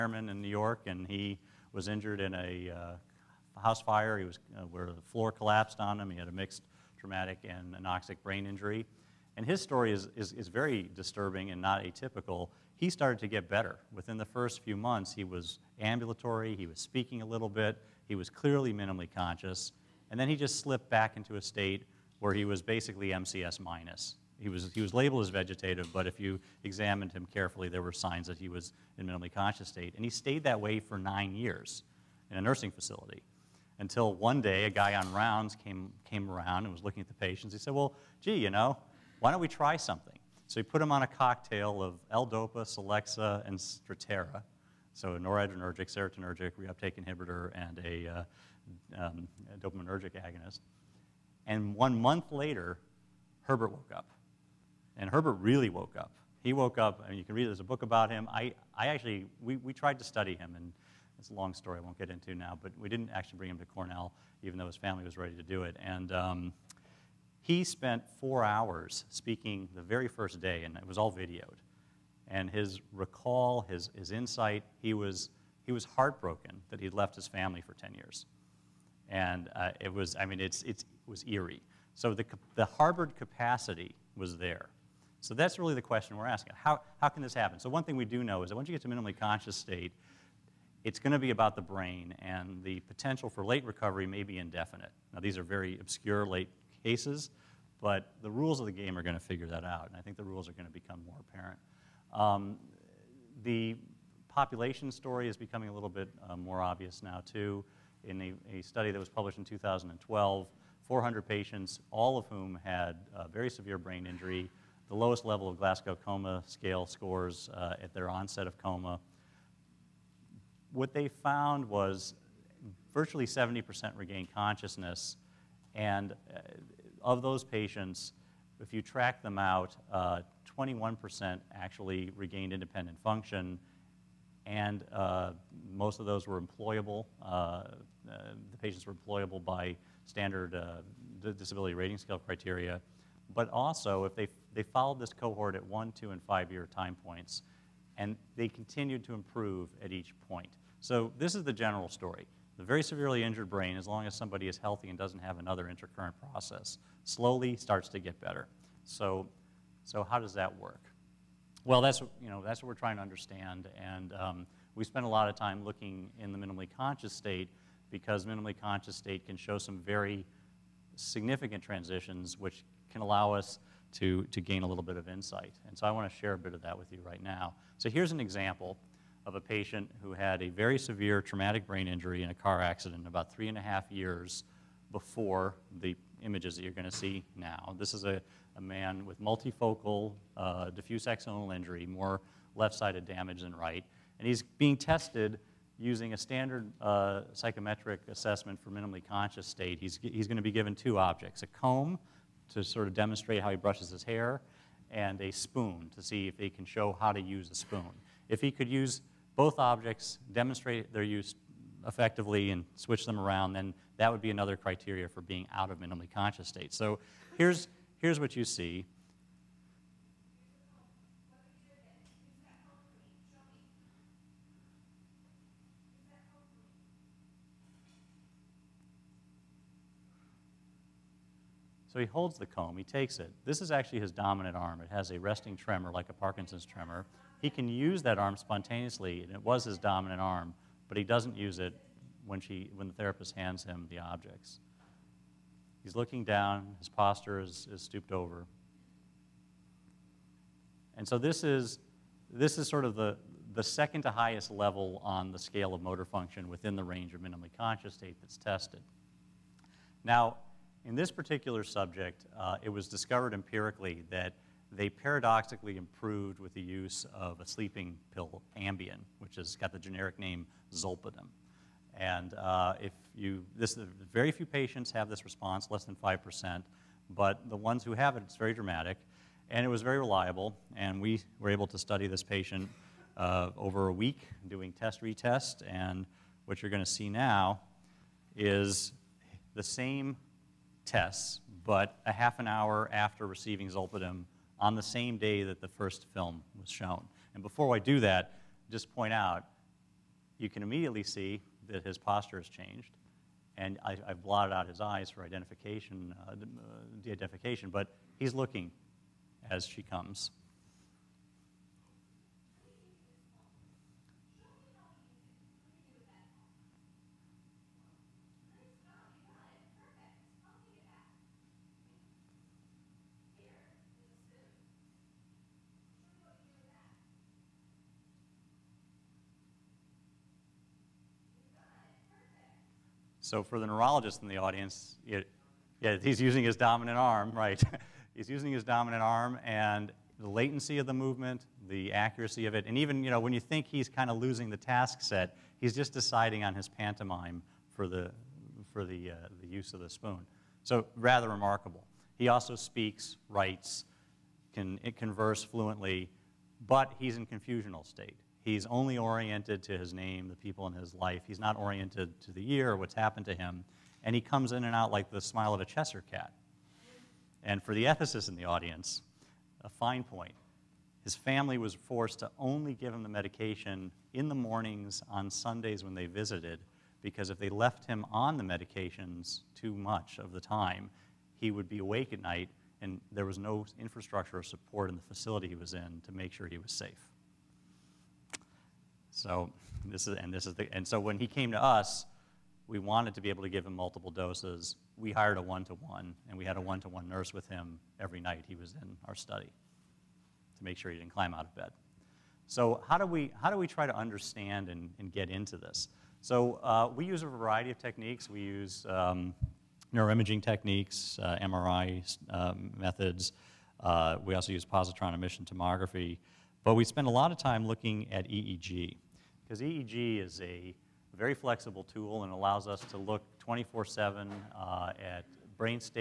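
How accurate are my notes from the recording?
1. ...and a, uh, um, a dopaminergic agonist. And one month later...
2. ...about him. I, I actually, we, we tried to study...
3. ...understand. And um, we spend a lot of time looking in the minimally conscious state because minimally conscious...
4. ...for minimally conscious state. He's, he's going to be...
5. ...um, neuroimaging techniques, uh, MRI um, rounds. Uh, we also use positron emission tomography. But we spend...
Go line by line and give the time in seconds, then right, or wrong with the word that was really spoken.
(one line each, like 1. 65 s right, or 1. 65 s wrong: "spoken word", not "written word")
1. 47 s right
2. 57 s right
3. 163 s right
4. 198 s right
5. 408 s wrong: "methods", not "rounds".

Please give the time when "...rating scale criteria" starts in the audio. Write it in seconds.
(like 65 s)
141 s.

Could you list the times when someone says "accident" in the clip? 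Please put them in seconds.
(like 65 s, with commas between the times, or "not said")
182 s.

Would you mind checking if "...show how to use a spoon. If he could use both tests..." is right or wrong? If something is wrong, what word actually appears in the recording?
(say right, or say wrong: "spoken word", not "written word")
wrong: "objects", not "tests".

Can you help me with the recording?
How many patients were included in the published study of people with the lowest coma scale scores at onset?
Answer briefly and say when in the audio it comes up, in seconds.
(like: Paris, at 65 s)
400, at 110 s.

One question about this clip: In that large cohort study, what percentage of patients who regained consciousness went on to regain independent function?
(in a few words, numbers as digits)
21%.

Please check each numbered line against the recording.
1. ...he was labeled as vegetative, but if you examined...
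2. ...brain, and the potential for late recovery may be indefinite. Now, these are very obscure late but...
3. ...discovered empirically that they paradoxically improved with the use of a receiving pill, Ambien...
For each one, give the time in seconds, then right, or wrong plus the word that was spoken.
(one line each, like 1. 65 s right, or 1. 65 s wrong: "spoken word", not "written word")
1. 24 s right
2. 91 s right
3. 262 s wrong: "sleeping", not "receiving".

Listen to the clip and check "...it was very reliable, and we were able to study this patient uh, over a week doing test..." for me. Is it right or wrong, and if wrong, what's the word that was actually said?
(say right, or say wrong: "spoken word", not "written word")
right.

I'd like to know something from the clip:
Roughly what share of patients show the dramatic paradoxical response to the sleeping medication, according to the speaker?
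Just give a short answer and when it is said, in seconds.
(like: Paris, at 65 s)
Less than 5%, at 275 s.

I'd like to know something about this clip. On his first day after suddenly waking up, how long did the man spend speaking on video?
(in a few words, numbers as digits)
4 hours.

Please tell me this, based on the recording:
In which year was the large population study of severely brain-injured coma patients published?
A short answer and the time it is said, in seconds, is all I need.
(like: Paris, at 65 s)
2012, at 109 s.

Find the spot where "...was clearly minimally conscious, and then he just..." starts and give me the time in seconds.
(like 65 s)
18 s.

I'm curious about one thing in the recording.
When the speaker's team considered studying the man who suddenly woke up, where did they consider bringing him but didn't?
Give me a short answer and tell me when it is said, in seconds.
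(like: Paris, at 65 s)
Cornell, at 63 s.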